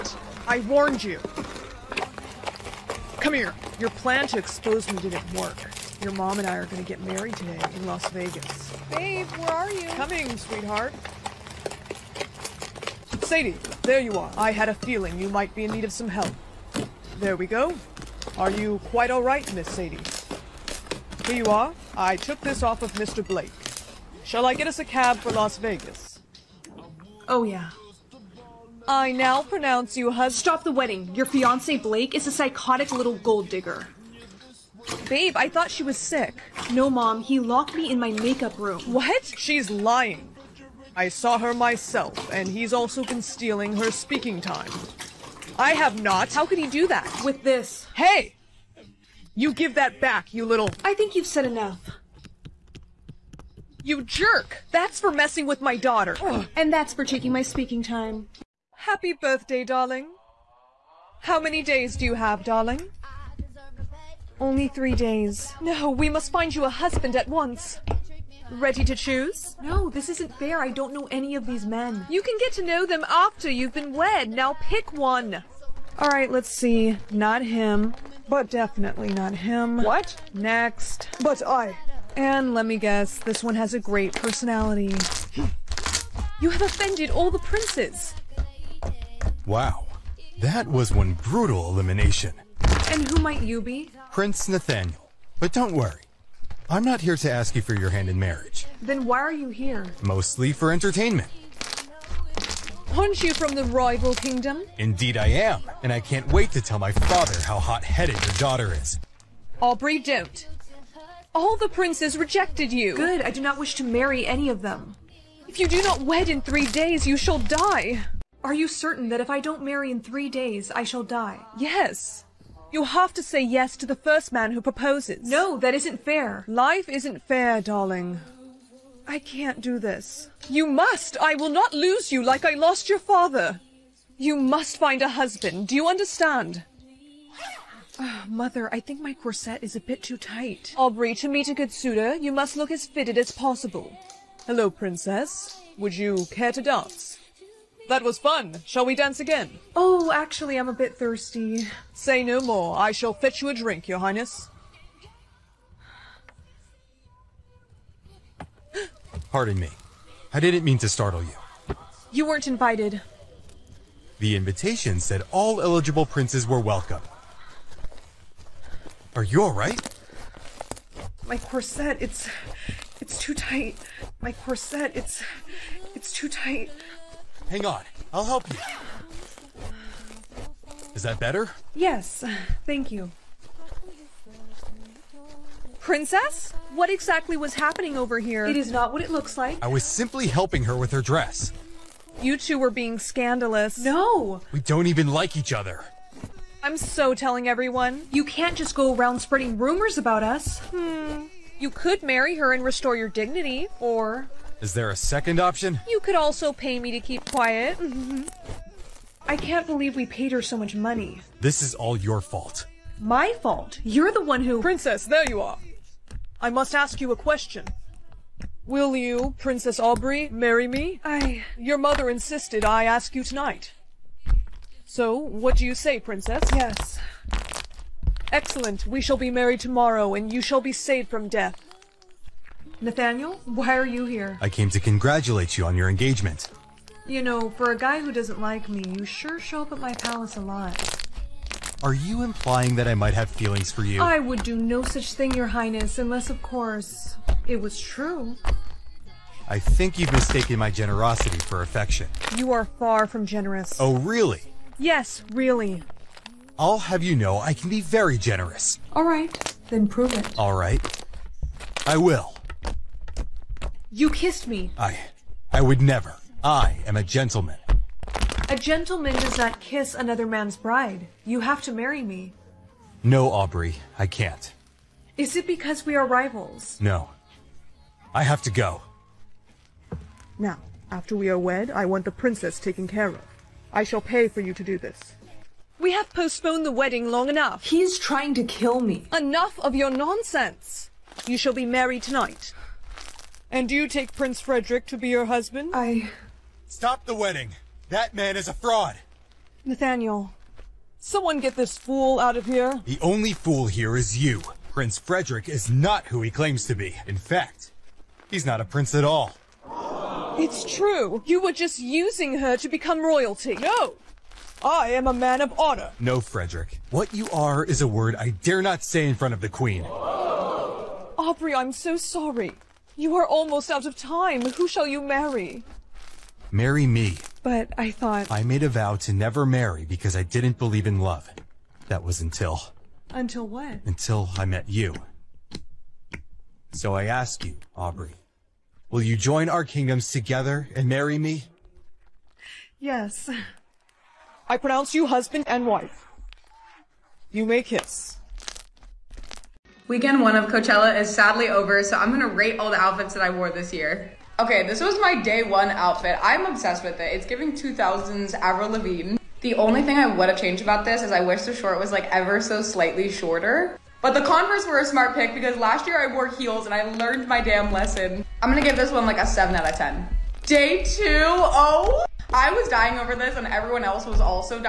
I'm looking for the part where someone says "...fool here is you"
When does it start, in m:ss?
5:03.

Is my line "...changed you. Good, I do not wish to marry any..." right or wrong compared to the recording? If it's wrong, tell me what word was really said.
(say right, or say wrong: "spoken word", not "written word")
wrong: "rejected", not "changed".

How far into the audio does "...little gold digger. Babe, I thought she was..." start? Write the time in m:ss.
0:32.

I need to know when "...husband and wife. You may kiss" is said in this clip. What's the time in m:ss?
5:45.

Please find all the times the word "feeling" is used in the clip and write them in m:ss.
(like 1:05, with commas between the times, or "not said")
0:14, 4:03.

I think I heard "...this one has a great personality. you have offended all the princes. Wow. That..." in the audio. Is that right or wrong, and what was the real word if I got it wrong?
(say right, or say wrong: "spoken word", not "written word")
right.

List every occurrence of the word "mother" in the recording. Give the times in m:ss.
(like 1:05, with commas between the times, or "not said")
2:18, 3:41.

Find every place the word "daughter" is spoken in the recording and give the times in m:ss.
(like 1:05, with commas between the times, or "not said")
0:55, 1:48.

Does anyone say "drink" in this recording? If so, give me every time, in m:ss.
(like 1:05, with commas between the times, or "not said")
2:33.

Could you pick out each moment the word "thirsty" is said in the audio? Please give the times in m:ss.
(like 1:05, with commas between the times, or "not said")
2:30.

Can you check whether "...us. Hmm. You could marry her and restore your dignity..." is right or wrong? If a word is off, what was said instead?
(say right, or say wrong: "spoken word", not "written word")
right.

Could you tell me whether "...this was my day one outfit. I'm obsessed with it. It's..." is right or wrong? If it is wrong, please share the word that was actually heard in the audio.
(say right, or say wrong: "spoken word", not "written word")
right.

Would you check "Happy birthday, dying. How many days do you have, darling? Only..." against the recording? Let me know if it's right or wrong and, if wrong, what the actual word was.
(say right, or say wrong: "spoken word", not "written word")
wrong: "darling", not "dying".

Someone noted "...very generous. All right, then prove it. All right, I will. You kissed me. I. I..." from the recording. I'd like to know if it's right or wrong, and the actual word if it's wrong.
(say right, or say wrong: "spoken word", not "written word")
right.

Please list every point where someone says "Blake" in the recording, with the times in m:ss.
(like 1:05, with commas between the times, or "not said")
0:23, 0:31.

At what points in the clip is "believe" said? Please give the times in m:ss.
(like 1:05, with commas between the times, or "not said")
3:29, 5:30.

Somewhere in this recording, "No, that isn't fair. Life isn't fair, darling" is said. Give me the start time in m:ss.
2:05.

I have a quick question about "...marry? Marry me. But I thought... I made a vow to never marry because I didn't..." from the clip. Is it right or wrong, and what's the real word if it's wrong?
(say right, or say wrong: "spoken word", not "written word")
right.